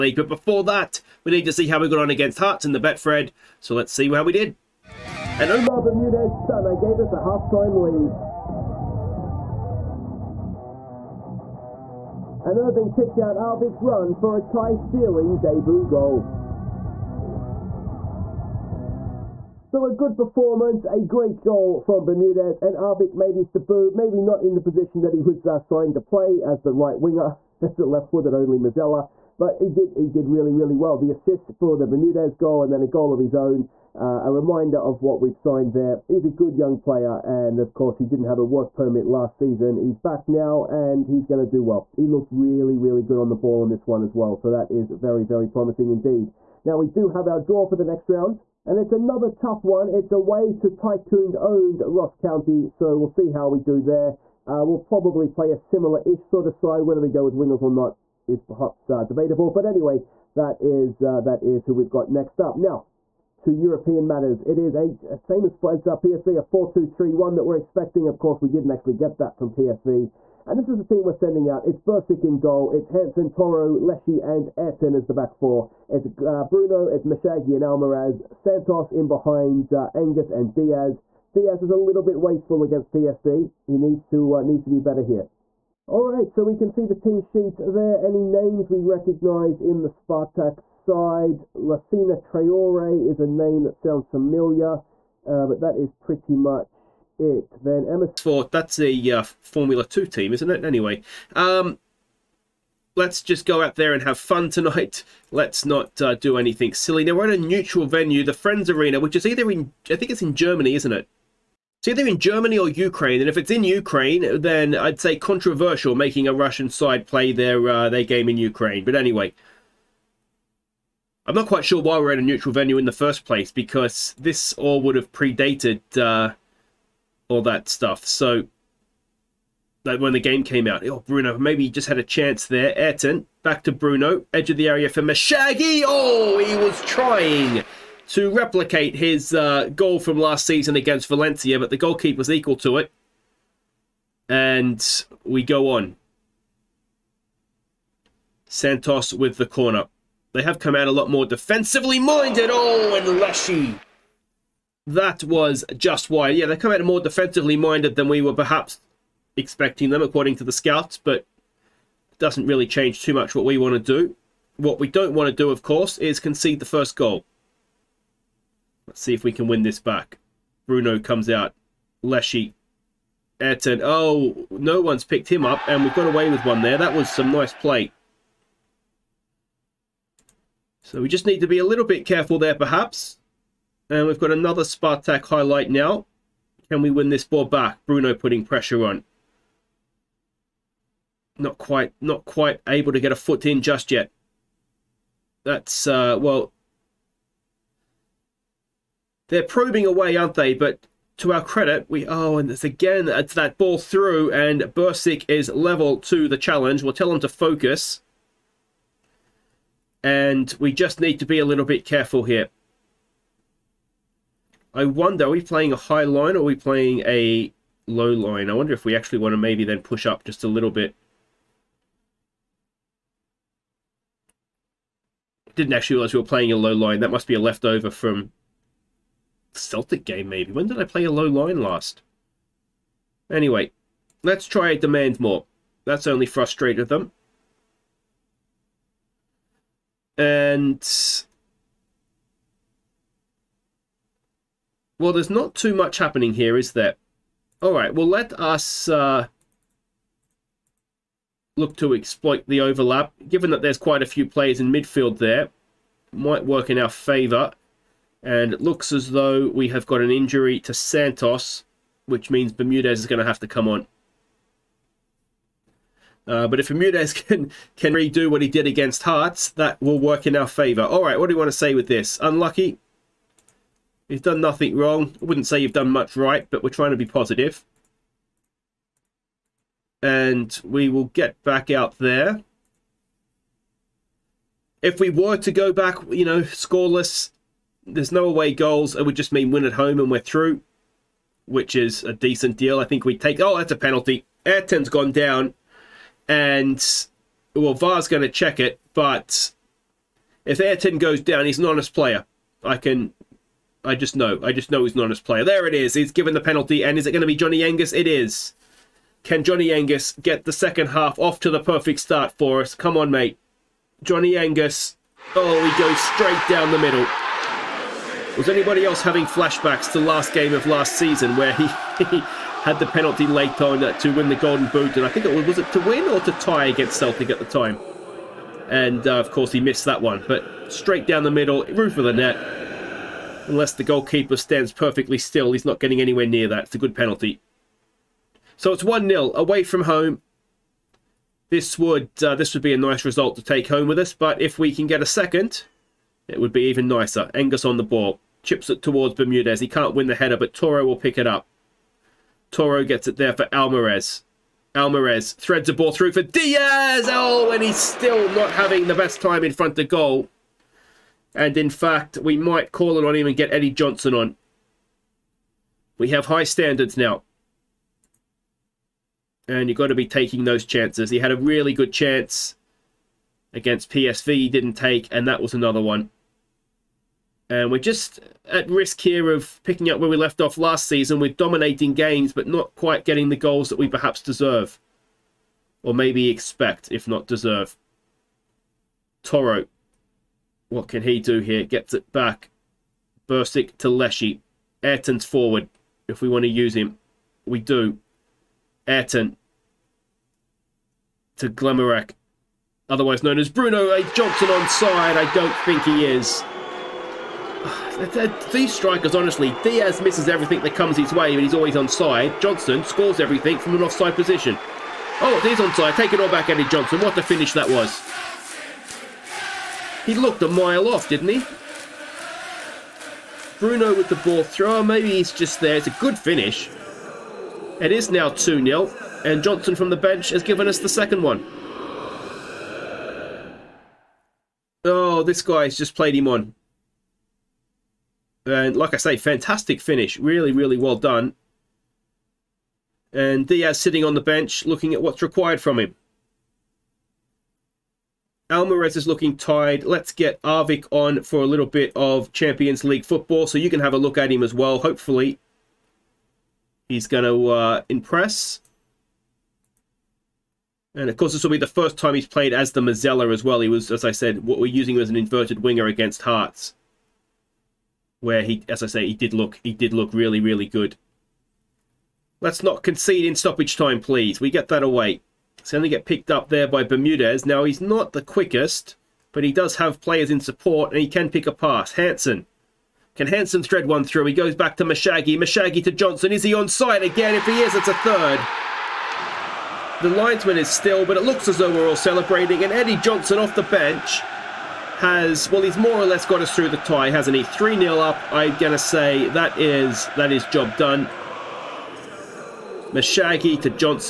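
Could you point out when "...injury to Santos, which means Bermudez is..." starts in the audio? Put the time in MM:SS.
04:20.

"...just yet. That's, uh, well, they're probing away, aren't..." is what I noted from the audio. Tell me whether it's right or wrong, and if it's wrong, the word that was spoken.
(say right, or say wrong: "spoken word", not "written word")
right.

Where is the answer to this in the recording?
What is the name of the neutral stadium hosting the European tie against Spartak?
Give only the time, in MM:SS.
01:48.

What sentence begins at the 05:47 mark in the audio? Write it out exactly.
Angus on the ball chips it towards Bermudez.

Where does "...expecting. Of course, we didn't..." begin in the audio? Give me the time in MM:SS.
01:07.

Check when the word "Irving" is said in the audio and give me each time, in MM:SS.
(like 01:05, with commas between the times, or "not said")
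00:12.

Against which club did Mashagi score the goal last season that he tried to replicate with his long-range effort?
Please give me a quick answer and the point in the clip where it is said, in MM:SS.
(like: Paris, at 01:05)
Valencia, at 02:21.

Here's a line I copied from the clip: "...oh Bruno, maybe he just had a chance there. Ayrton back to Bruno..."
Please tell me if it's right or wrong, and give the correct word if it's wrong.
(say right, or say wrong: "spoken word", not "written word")
right.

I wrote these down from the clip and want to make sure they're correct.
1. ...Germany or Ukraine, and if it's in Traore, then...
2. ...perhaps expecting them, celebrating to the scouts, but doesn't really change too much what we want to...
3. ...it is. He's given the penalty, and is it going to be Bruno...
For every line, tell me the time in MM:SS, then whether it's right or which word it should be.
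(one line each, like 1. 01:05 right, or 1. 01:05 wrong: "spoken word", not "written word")
1. 01:52 wrong: "Ukraine", not "Traore"
2. 02:38 wrong: "according", not "celebrating"
3. 05:05 wrong: "Johnny", not "Bruno".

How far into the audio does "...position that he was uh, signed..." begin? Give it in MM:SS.
00:24.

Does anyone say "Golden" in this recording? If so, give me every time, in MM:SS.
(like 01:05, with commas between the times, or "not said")
05:24.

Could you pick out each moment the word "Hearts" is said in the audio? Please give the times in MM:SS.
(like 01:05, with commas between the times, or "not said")
00:02, 04:29, 07:46.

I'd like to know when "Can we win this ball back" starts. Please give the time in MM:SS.
03:06.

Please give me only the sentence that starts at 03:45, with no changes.
Didn't actually realize we were playing a low line.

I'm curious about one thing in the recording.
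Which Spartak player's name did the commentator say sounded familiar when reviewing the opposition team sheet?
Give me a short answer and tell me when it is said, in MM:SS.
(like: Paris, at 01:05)
Lacina Traore, at 01:31.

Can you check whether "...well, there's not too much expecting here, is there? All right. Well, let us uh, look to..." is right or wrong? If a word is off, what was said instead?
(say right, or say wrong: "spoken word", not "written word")
wrong: "happening", not "expecting".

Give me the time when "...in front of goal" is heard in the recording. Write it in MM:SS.
05:59.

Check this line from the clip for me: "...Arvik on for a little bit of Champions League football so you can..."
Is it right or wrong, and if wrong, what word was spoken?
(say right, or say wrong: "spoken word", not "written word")
right.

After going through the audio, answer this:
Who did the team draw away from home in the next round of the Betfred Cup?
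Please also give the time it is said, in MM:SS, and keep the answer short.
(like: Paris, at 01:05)
Ross County, at 00:51.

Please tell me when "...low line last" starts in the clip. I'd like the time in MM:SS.
03:51.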